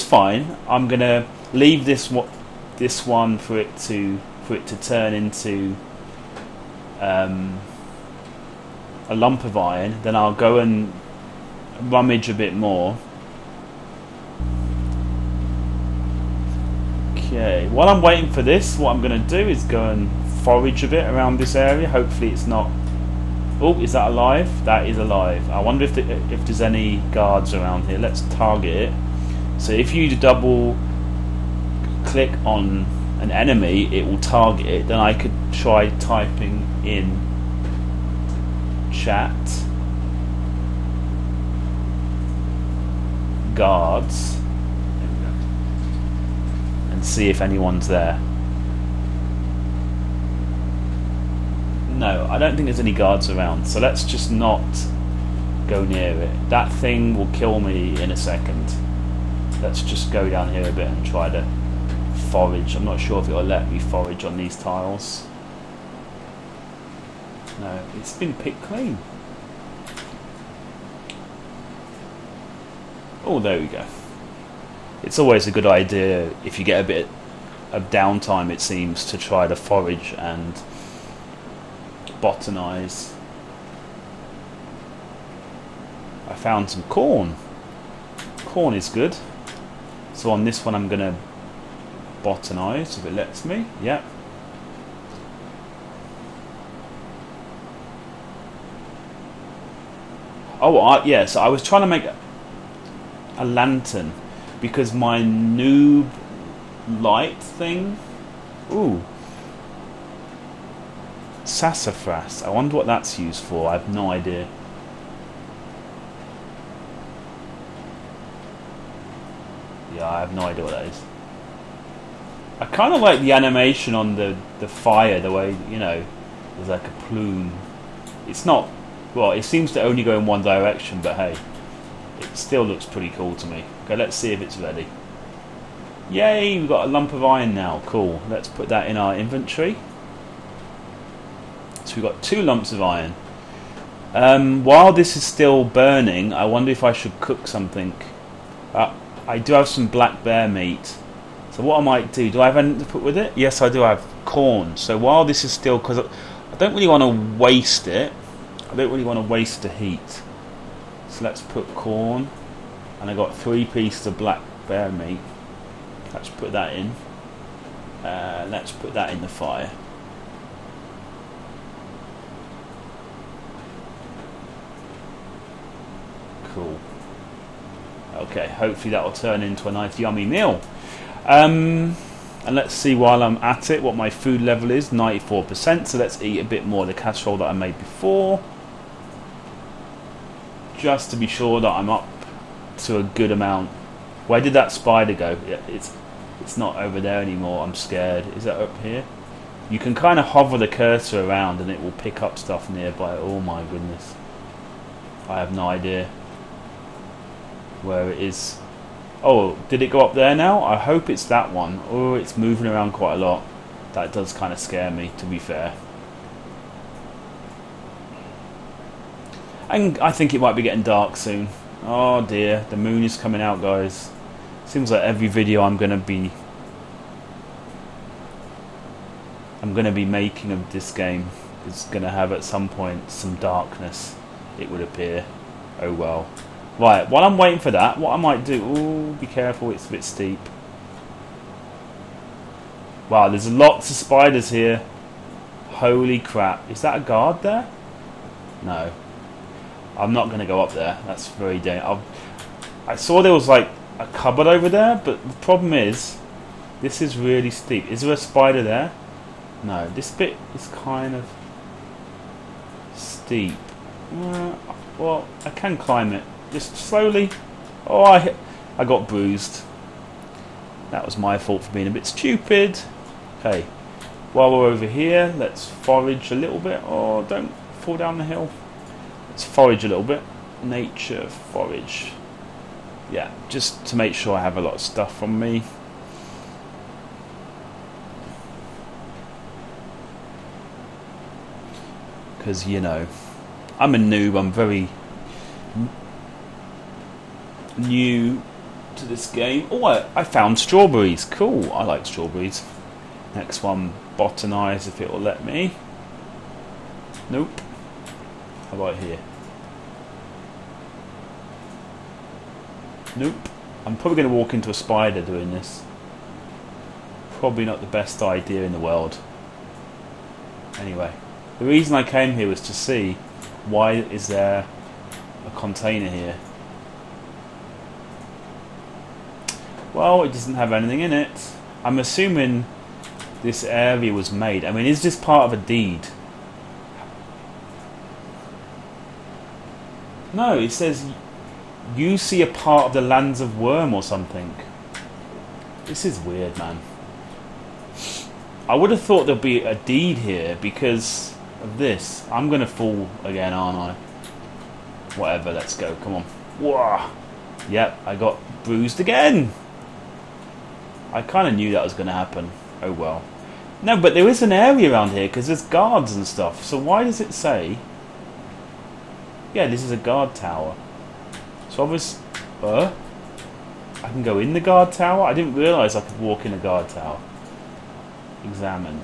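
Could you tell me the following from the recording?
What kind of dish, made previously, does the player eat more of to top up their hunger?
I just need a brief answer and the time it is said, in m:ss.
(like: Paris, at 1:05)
Casserole, at 3:06.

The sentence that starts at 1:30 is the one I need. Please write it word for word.
So on this one I'm going to botanize if it lets me.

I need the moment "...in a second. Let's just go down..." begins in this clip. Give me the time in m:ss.
0:57.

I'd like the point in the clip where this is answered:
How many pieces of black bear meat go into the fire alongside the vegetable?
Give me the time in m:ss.
2:43.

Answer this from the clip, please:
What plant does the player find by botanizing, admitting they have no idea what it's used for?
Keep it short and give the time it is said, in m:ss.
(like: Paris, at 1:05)
Sassafras, at 1:51.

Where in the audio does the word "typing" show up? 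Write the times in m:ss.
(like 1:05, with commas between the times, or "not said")
0:35.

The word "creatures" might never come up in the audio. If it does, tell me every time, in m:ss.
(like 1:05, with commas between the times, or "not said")
not said.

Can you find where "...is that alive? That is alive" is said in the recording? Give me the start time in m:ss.
0:23.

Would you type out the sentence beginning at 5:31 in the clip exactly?
I'm assuming this area was made.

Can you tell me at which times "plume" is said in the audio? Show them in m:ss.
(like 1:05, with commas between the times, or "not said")
2:07.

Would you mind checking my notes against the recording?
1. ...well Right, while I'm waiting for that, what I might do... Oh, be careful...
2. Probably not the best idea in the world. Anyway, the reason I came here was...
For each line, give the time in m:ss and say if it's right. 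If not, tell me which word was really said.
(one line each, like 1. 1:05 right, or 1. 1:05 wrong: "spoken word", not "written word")
1. 3:55 right
2. 5:17 right.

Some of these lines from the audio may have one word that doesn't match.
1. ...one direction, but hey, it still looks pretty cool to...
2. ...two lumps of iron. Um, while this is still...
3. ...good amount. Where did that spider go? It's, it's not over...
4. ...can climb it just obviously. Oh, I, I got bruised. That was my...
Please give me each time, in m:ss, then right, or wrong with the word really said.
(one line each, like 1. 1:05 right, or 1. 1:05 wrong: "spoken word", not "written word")
1. 2:10 right
2. 2:22 right
3. 3:13 right
4. 4:25 wrong: "slowly", not "obviously".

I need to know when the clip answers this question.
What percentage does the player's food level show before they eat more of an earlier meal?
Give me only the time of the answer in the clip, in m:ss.
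3:04.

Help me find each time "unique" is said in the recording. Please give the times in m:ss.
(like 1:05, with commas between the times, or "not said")
not said.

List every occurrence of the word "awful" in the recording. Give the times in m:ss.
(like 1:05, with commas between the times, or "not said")
not said.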